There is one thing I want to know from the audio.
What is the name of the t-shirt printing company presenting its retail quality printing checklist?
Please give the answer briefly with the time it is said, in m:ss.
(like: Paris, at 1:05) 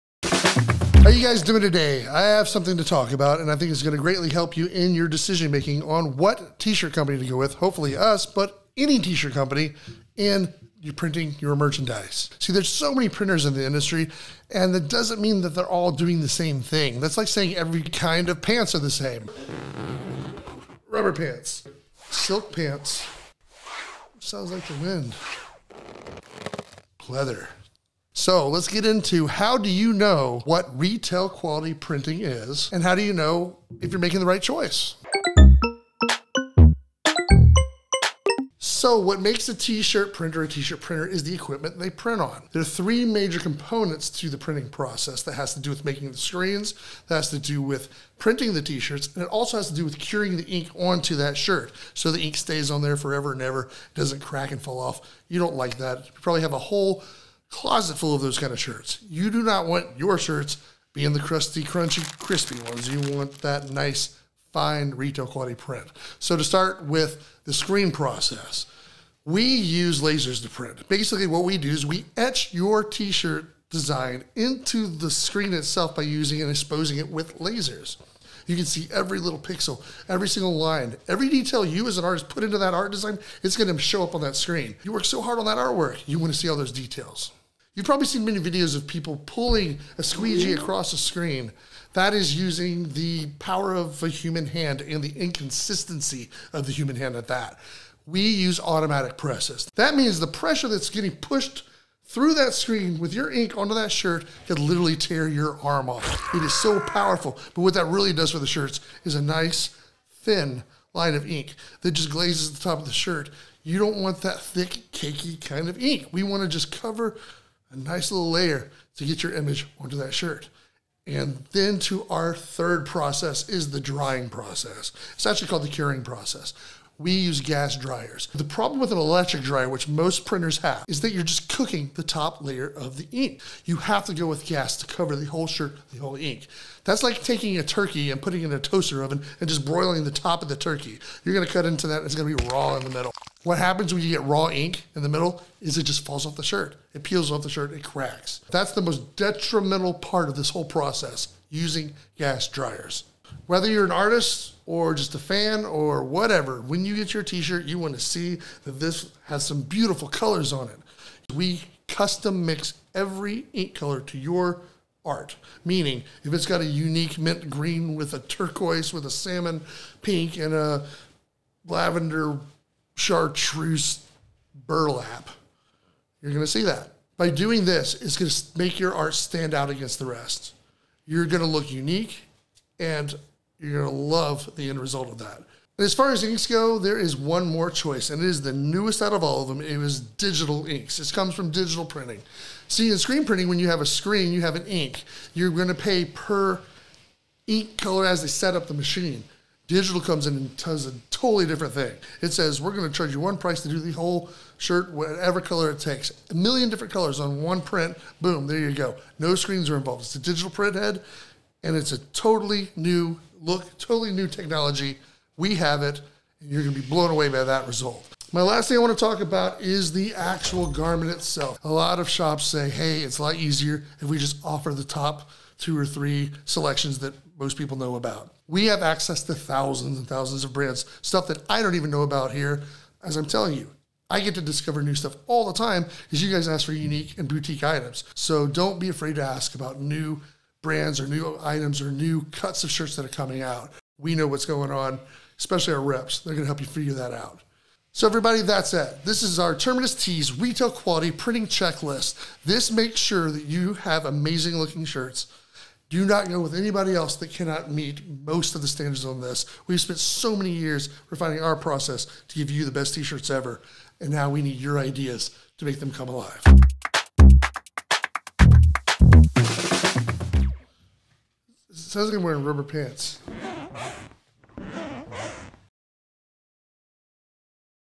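Terminus Tees, at 4:09.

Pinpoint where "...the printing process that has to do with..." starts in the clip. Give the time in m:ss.
0:44.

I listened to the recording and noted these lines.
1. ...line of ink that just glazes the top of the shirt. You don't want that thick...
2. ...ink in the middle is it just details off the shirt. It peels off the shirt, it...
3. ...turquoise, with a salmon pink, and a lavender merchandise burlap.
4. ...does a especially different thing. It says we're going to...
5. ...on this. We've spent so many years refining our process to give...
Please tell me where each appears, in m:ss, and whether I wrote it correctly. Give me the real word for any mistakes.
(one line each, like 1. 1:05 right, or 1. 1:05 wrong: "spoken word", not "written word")
1. 1:50 right
2. 2:24 wrong: "falls", not "details"
3. 2:48 wrong: "chartreuse", not "merchandise"
4. 3:20 wrong: "totally", not "especially"
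5. 4:19 right.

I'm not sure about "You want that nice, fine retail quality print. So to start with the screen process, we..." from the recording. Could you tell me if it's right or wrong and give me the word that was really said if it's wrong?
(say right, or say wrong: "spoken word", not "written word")
right.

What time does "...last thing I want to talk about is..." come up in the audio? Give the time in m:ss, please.
3:38.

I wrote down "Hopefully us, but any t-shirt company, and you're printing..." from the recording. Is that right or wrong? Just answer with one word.
right.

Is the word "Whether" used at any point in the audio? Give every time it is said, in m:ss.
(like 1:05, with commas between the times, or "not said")
2:33.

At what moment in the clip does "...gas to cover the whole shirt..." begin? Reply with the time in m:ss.
2:14.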